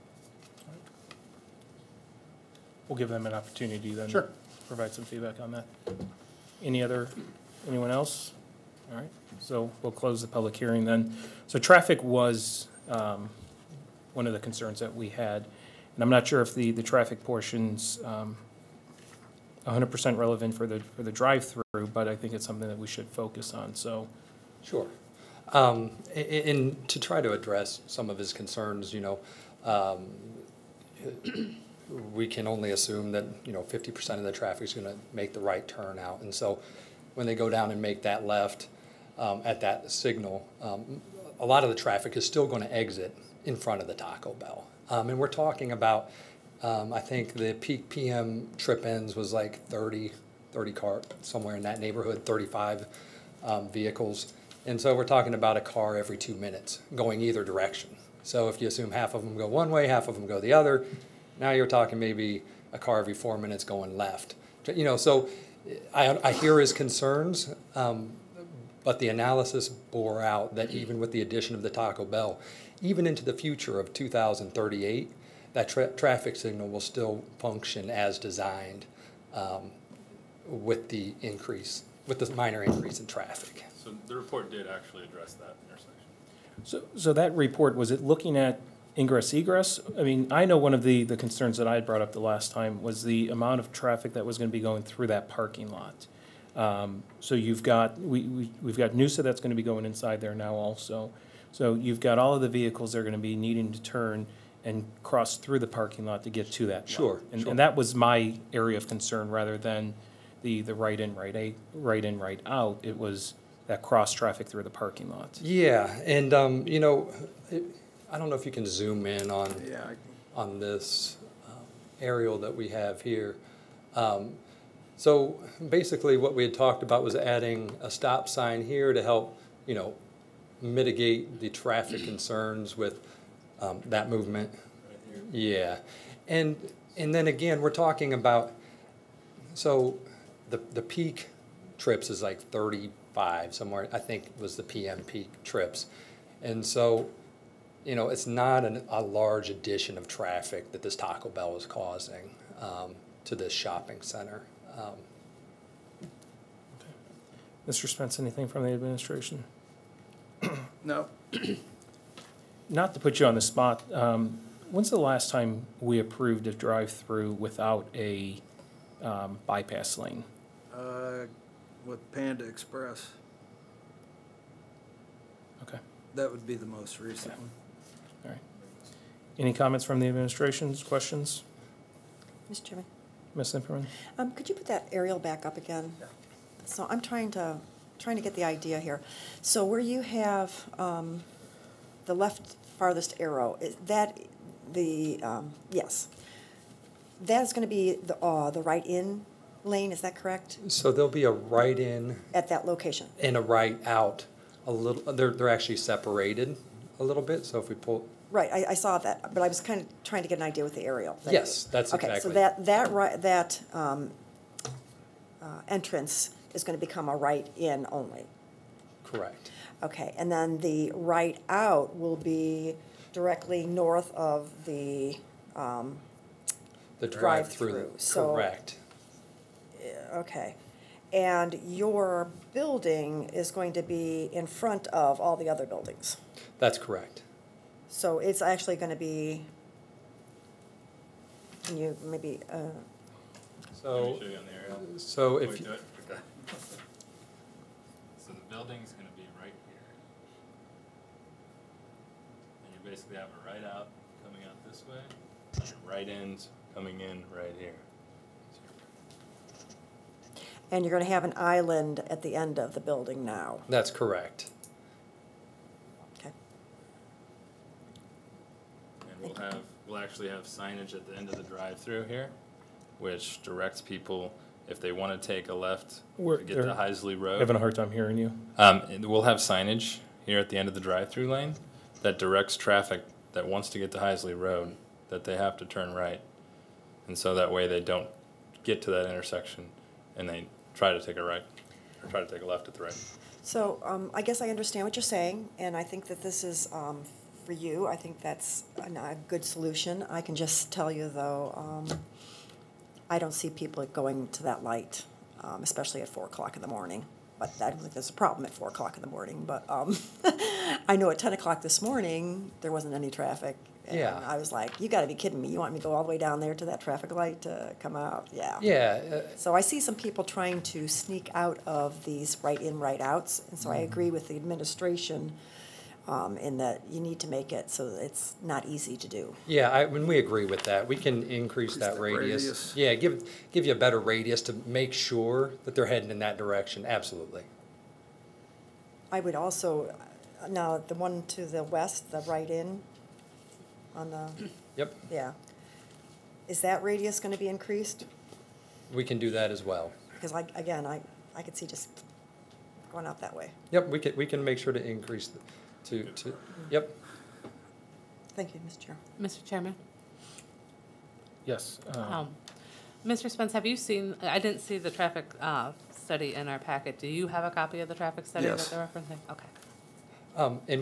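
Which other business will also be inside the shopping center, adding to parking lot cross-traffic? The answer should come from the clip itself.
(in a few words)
Noosa.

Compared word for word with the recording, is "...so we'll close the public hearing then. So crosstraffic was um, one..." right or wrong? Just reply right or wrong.
wrong.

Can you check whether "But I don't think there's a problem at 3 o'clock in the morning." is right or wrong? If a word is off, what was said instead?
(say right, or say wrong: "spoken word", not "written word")
wrong: "4", not "3".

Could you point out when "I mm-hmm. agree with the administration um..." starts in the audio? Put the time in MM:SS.
05:23.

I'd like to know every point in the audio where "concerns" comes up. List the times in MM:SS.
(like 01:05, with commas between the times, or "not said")
00:14, 00:28, 01:06, 01:31, 01:48, 02:12.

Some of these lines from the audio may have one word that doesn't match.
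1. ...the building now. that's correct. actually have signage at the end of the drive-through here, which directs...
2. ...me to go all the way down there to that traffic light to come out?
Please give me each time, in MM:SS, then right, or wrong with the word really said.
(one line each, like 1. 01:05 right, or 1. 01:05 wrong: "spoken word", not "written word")
1. 04:22 right
2. 05:15 right.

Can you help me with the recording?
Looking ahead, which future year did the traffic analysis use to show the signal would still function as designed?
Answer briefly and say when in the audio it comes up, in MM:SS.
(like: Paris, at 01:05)
2038, at 01:13.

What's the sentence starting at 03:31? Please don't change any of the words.
Yes, that's Okay, so that, that, right that um, uh, entrance is going to become a right-in only.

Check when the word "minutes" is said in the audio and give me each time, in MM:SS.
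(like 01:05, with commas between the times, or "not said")
00:56, 01:03.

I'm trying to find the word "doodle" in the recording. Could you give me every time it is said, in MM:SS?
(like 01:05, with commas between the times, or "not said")
not said.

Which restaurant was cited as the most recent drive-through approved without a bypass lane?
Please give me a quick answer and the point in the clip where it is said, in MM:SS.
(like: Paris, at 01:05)
Panda Express, at 02:52.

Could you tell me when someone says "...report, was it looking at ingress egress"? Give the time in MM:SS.
01:27.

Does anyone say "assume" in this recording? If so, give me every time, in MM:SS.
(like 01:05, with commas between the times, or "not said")
00:32, 00:58.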